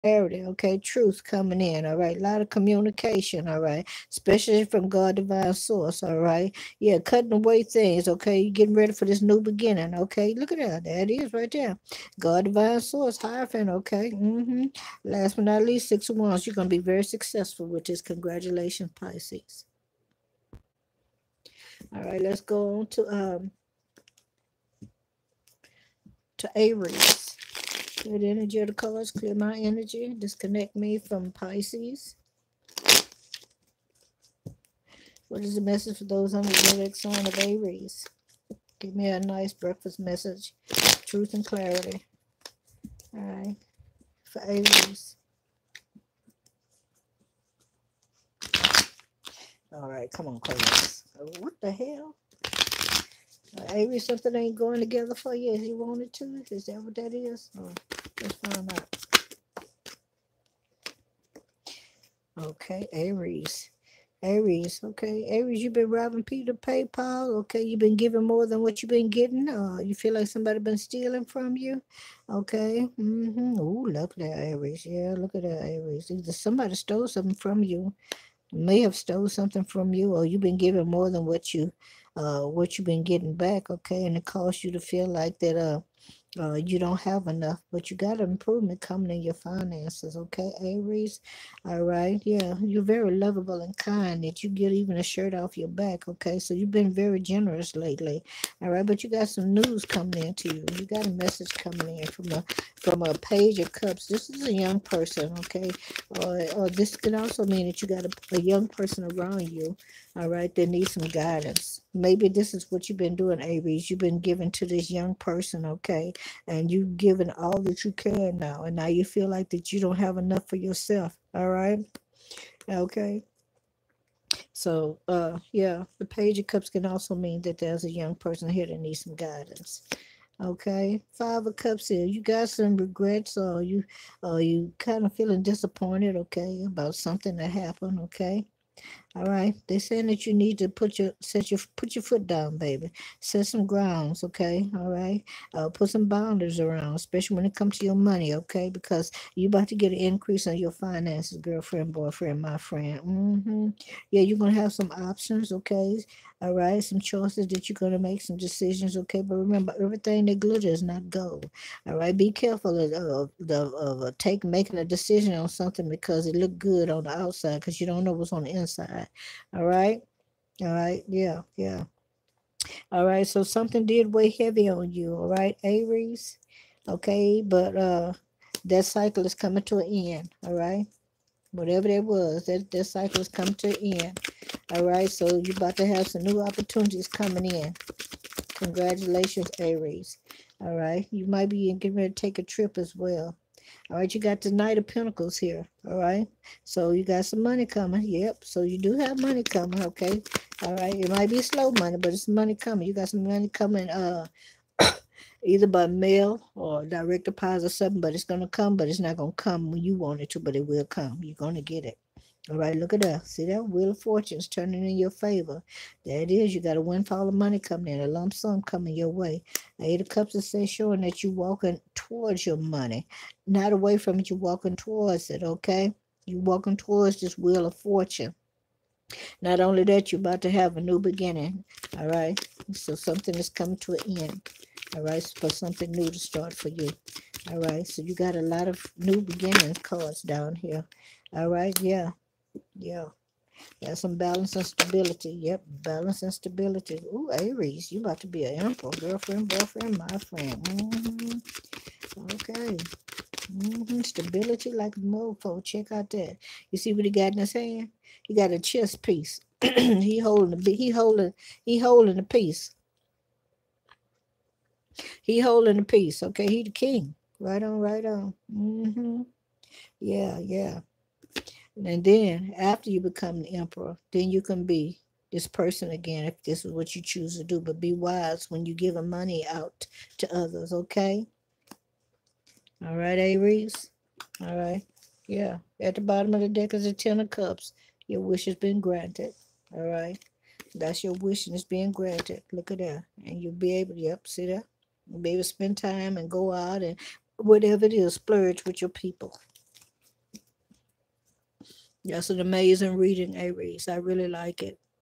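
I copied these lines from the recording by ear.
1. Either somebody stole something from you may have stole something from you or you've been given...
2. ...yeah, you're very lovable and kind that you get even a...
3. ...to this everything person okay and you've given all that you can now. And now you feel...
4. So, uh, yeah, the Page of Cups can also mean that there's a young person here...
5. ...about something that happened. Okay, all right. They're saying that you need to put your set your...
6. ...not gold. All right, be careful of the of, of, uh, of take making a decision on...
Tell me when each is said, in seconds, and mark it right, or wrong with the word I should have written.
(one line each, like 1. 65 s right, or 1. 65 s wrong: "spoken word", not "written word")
1. 76 s right
2. 92 s right
3. 114 s wrong: "young", not "everything"
4. 124 s right
5. 136 s right
6. 160 s right.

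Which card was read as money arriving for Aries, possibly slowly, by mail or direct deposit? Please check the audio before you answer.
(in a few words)
Knight of Pentacles.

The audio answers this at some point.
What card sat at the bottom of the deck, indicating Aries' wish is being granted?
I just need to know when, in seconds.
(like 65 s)
286 s.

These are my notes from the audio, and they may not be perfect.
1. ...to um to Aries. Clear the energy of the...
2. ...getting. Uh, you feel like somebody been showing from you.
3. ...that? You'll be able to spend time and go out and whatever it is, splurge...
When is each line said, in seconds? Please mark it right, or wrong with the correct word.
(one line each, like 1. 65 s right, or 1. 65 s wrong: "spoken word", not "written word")
1. 22 s right
2. 69 s wrong: "stealing", not "showing"
3. 294 s right.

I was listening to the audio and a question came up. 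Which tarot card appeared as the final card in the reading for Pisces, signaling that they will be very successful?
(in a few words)
Six of Wands.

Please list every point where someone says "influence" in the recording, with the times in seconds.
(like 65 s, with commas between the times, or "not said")
not said.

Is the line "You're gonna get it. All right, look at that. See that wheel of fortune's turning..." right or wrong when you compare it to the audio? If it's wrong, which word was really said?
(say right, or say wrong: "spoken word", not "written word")
right.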